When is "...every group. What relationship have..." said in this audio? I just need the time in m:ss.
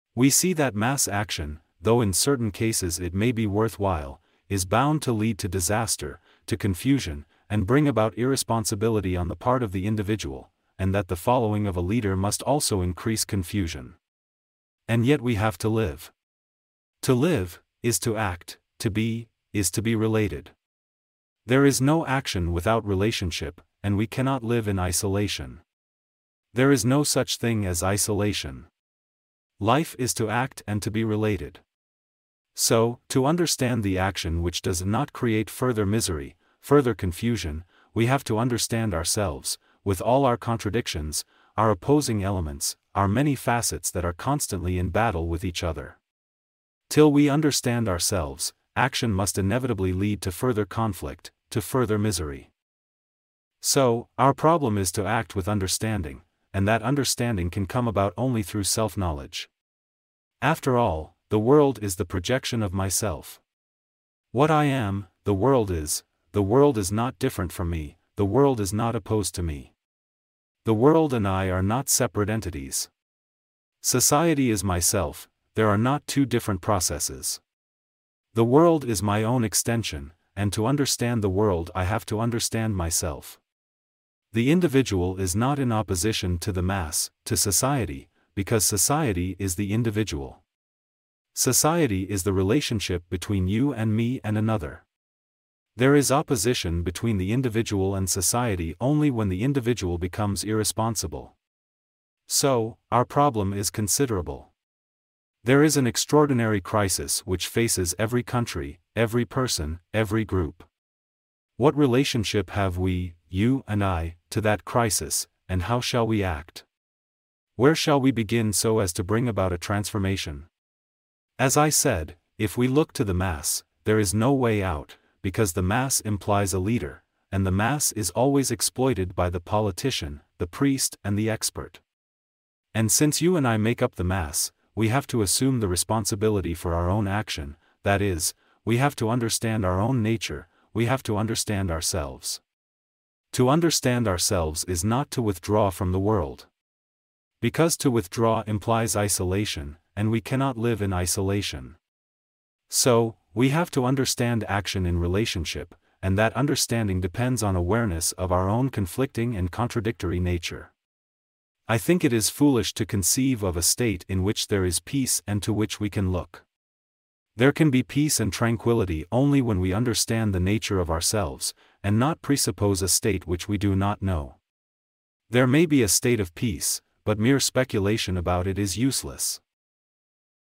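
1:49.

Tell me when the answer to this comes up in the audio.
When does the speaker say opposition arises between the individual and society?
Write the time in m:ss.
1:40.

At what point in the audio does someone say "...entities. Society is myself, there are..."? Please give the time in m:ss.
1:12.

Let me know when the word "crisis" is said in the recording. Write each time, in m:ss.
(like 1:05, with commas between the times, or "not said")
1:46, 1:54.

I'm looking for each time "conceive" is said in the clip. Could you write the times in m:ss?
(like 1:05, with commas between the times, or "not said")
2:42.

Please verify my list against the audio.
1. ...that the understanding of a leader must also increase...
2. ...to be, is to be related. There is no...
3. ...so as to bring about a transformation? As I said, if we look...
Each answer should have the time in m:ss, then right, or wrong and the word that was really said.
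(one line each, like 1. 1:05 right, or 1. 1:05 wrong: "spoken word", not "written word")
1. 0:10 wrong: "following", not "understanding"
2. 0:18 right
3. 1:58 right.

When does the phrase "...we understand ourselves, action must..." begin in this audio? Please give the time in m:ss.
0:47.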